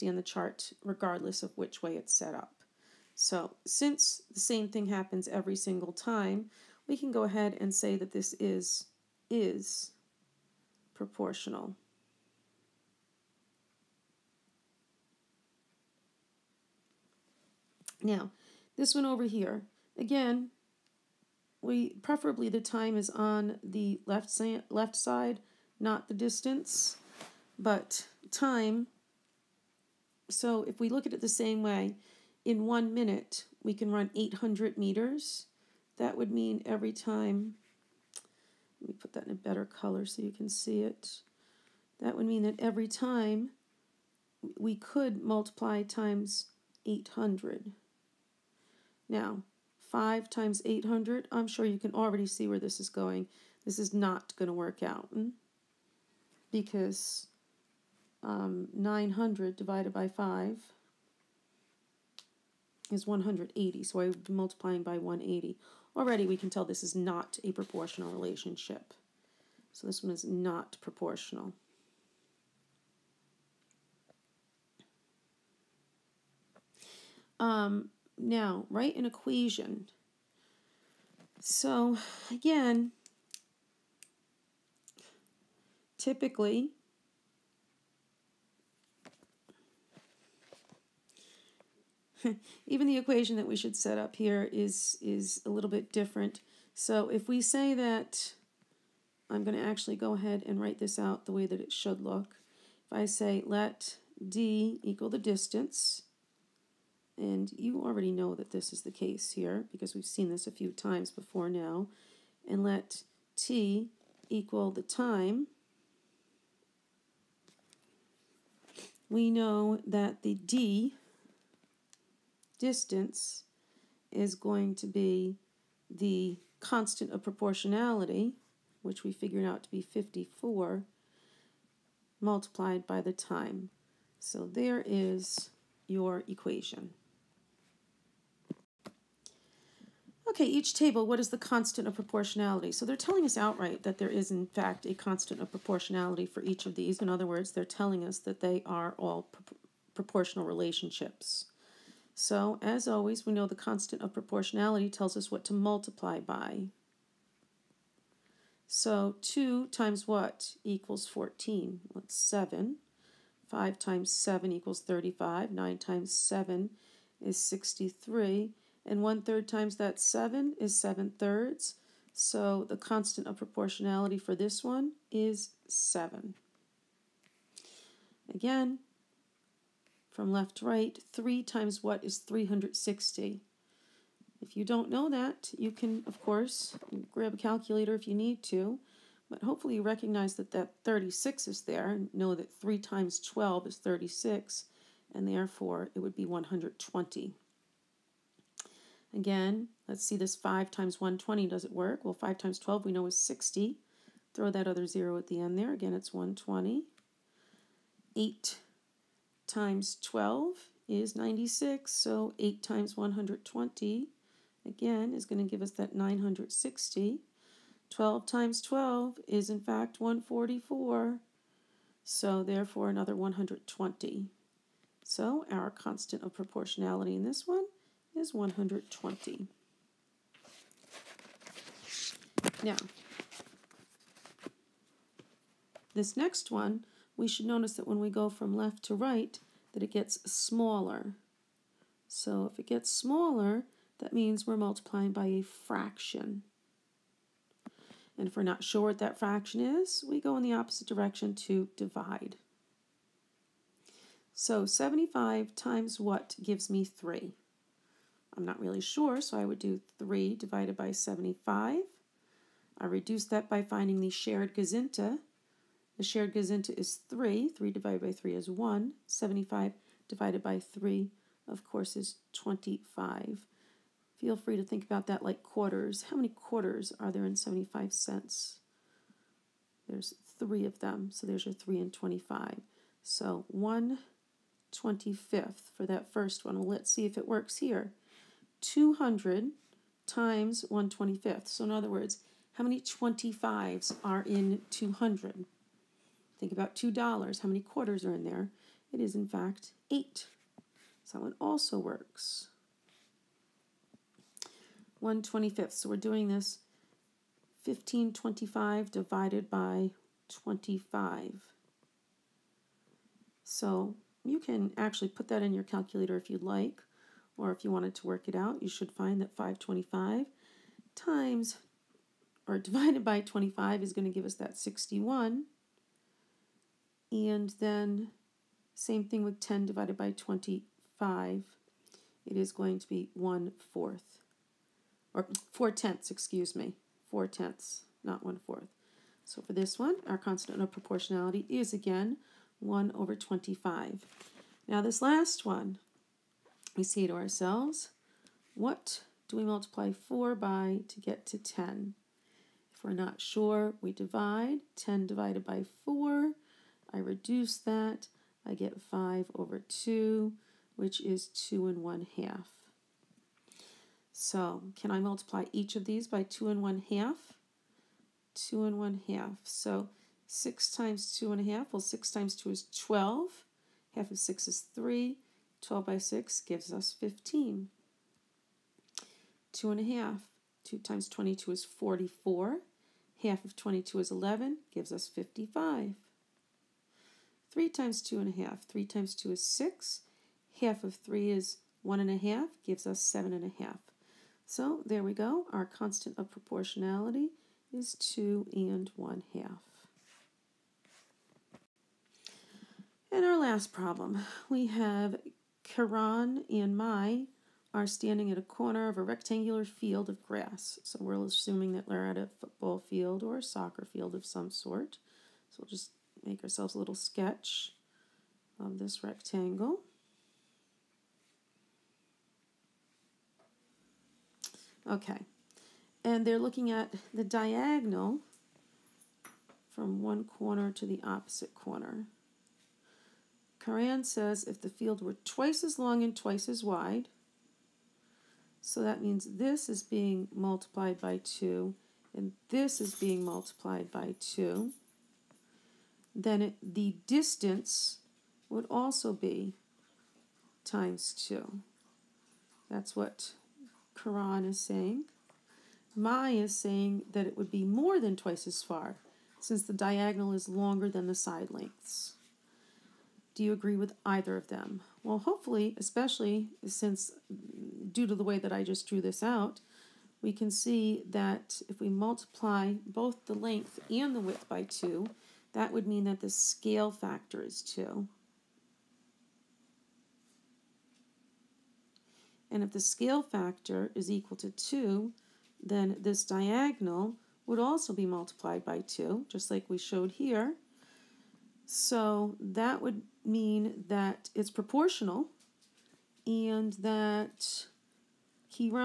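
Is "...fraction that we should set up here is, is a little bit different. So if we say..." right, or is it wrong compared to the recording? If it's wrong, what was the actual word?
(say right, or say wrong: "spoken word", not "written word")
wrong: "equation", not "fraction".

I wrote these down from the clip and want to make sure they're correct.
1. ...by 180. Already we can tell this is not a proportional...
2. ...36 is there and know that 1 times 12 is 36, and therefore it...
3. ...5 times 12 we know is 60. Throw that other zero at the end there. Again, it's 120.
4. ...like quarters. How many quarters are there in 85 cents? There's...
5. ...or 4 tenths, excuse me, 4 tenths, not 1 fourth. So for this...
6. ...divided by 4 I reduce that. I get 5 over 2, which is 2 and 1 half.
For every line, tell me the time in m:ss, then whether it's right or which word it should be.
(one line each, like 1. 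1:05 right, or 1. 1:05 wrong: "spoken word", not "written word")
1. 1:04 right
2. 3:10 wrong: "3", not "1"
3. 3:22 right
4. 4:35 wrong: "75", not "85"
5. 5:35 right
6. 5:55 right.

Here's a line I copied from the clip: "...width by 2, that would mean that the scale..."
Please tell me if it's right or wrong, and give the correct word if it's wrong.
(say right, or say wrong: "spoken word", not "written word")
right.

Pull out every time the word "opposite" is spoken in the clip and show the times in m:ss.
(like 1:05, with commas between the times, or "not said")
4:10, 7:11.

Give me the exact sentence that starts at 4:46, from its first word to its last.
Well, let's see if it works here.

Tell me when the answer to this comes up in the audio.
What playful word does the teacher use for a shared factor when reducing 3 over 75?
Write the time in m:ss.
4:24.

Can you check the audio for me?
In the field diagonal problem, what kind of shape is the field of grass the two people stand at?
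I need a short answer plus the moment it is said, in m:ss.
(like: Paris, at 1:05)
rectangular, at 6:49.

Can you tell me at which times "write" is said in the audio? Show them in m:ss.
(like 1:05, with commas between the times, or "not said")
1:18, 1:40.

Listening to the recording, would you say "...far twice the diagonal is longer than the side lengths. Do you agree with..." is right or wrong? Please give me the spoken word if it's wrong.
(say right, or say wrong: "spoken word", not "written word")
wrong: "since", not "twice".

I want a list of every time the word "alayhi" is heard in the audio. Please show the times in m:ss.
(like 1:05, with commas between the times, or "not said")
not said.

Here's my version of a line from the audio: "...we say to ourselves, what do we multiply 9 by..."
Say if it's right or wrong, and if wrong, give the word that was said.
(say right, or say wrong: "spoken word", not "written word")
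wrong: "4", not "9".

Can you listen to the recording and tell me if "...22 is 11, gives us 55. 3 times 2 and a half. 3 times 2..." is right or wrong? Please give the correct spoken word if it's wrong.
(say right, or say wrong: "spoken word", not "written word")
right.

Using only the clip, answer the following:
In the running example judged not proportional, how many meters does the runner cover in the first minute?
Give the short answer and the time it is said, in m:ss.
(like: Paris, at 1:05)
800, at 0:34.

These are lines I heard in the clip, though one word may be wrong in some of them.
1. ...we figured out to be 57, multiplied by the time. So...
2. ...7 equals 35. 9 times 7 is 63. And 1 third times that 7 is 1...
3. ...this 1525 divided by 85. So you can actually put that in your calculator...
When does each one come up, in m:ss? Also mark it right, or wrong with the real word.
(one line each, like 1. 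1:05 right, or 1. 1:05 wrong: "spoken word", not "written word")
1. 2:09 wrong: "54", not "57"
2. 2:44 wrong: "7", not "1"
3. 5:06 wrong: "25", not "85".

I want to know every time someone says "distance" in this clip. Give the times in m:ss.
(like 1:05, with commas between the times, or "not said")
0:26, 1:45, 2:02, 7:27.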